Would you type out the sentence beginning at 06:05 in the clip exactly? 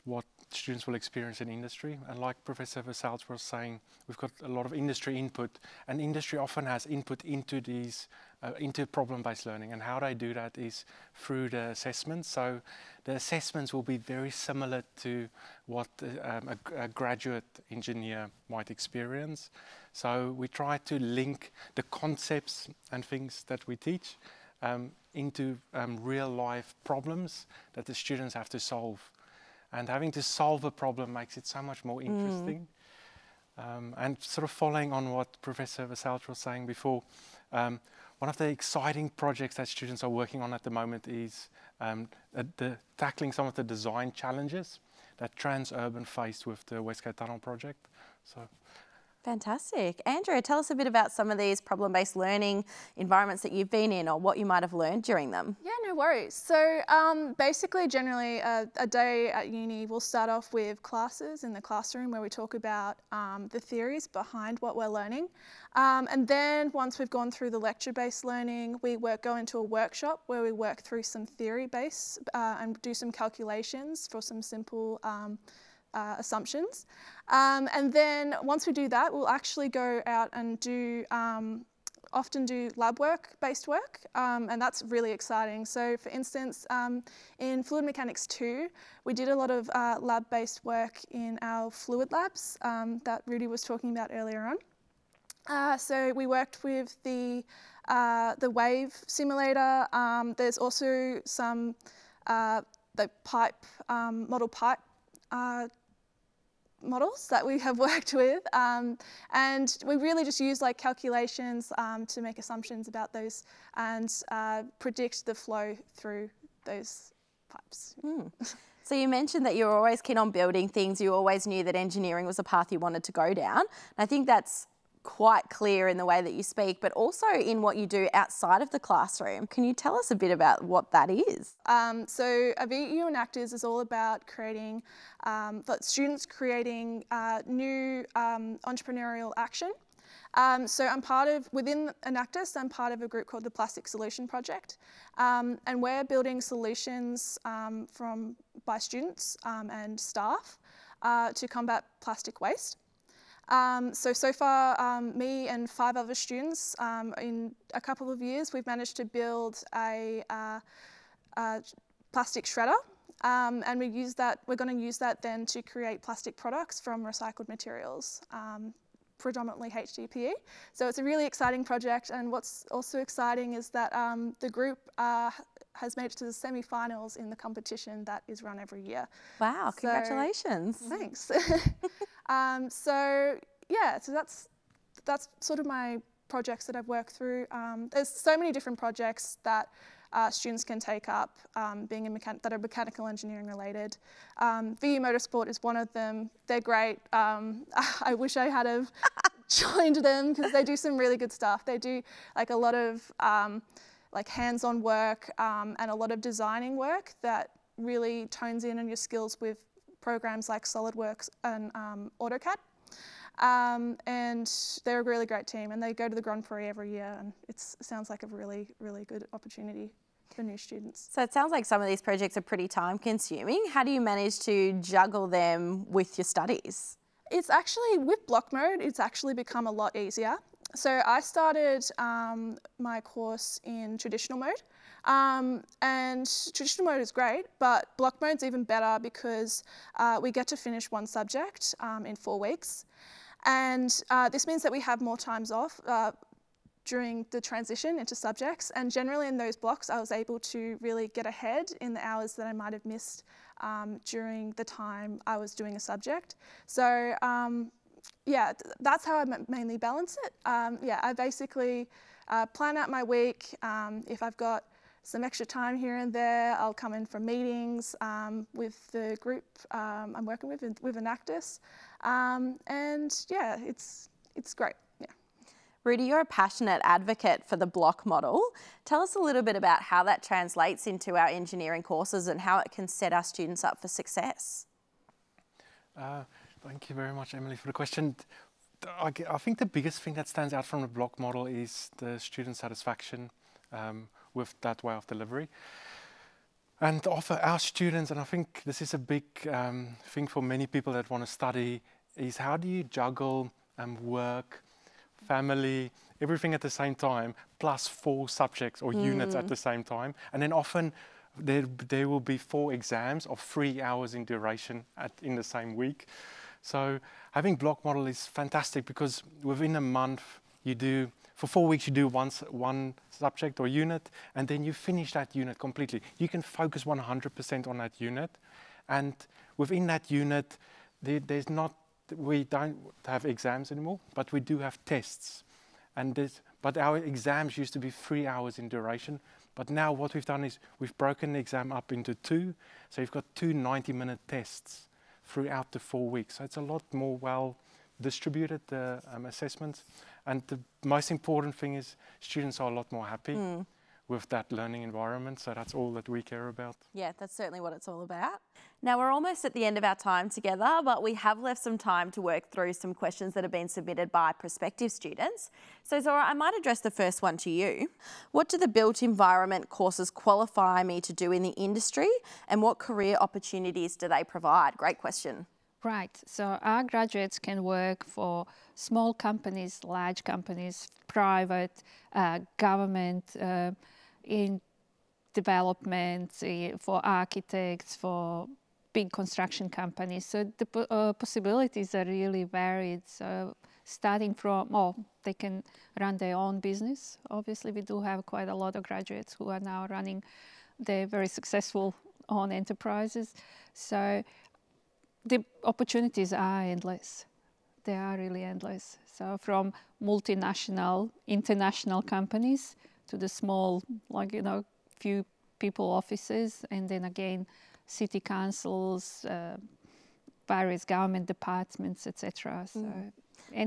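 So Zora, I might address the first one to you.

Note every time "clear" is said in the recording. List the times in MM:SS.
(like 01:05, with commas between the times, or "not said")
02:05.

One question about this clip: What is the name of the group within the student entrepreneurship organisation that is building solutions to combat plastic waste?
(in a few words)
Plastic Solution Project.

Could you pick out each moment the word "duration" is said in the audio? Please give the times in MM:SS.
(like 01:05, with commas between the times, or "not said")
05:14, 05:38.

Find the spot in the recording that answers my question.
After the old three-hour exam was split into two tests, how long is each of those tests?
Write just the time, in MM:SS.
05:43.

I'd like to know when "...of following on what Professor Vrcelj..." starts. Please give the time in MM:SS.
00:34.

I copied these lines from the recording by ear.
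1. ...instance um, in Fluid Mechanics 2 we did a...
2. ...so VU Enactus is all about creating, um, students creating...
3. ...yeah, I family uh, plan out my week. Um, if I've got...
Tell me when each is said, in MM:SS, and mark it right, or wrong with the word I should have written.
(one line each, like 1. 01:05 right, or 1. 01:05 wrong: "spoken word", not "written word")
1. 01:26 right
2. 02:12 right
3. 04:20 wrong: "basically", not "family".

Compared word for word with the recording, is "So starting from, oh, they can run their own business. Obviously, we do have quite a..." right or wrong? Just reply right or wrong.
right.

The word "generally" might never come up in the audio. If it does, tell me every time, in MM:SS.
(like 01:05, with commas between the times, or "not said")
00:57, 04:08.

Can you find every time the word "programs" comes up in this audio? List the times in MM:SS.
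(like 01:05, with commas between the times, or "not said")
03:30.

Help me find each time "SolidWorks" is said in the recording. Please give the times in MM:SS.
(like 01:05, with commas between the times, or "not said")
03:30.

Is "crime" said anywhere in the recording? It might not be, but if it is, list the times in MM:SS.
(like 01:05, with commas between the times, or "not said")
not said.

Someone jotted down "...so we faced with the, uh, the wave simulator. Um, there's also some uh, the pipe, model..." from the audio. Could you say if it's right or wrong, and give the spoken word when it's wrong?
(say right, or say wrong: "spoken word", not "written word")
wrong: "worked", not "faced".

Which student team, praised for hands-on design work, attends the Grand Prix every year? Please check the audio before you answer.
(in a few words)
VU Motorsport.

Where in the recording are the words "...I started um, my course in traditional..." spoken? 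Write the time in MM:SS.
03:51.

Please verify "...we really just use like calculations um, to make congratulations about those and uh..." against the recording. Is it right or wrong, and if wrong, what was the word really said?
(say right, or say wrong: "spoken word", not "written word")
wrong: "assumptions", not "congratulations".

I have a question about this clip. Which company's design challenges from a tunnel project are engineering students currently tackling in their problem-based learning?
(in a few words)
Transurban.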